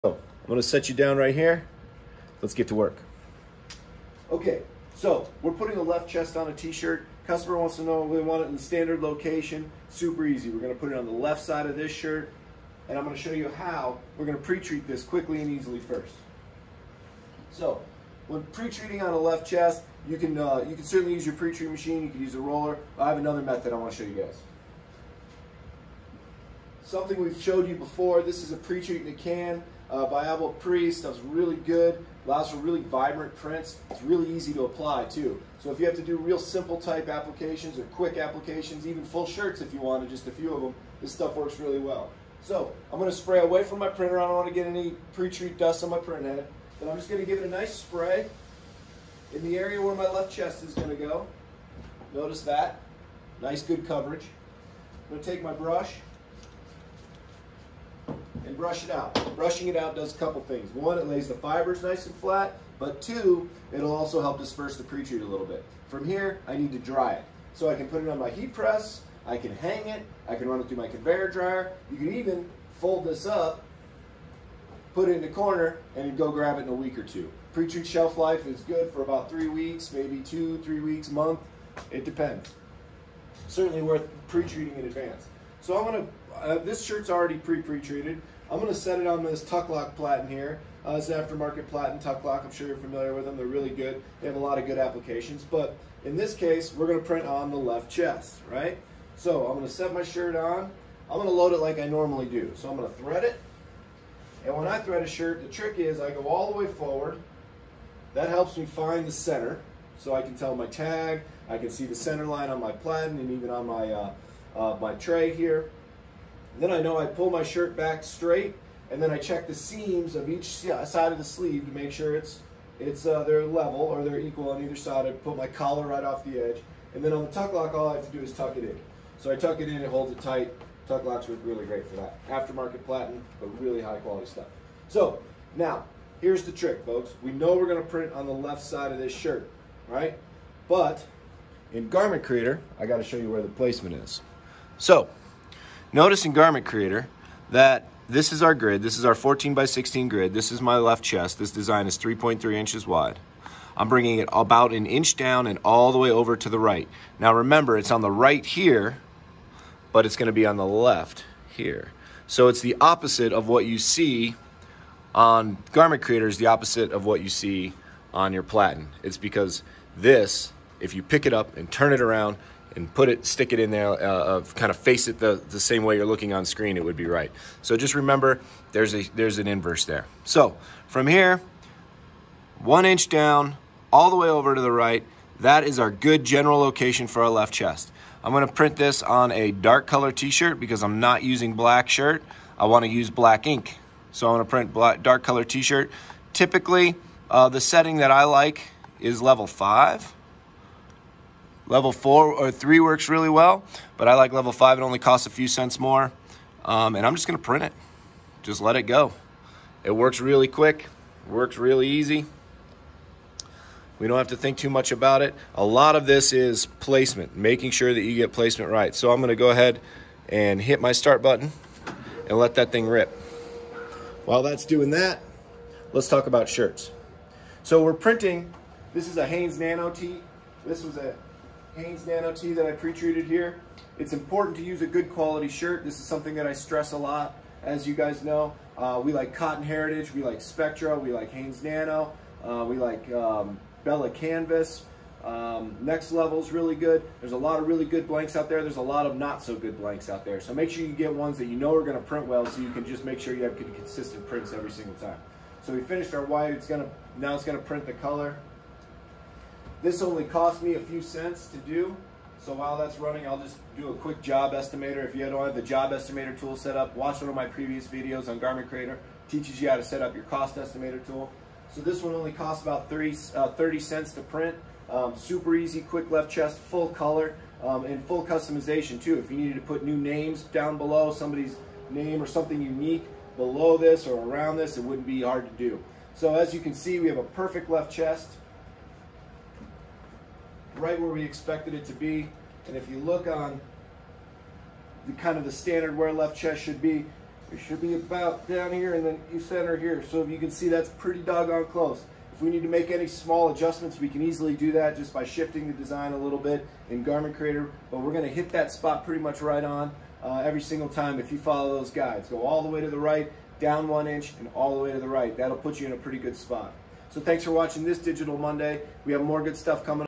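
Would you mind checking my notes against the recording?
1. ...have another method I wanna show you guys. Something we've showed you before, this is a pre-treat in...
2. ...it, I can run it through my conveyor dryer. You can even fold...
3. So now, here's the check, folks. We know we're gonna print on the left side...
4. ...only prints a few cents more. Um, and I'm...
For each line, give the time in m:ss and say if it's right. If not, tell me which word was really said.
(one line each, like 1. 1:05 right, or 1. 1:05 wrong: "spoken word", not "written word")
1. 0:23 right
2. 1:09 right
3. 2:14 wrong: "trick", not "check"
4. 3:24 wrong: "costs", not "prints".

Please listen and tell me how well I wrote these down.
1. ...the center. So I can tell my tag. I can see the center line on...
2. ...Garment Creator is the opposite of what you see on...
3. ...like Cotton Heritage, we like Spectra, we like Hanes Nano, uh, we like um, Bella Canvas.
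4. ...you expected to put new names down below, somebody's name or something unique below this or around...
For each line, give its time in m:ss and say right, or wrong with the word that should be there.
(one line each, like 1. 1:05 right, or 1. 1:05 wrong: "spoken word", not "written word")
1. 1:49 right
2. 2:45 right
3. 3:59 right
4. 4:39 wrong: "needed", not "expected".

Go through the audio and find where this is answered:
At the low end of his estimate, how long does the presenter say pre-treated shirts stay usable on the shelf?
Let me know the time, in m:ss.
1:19.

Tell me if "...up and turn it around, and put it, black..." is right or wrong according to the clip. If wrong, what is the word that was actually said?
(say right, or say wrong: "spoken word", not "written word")
wrong: "stick", not "black".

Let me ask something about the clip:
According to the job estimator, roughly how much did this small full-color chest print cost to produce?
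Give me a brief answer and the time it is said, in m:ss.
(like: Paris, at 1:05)
30 cents, at 4:33.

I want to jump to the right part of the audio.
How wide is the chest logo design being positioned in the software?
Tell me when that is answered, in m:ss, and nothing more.
2:31.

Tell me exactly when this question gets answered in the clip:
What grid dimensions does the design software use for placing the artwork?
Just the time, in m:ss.
2:29.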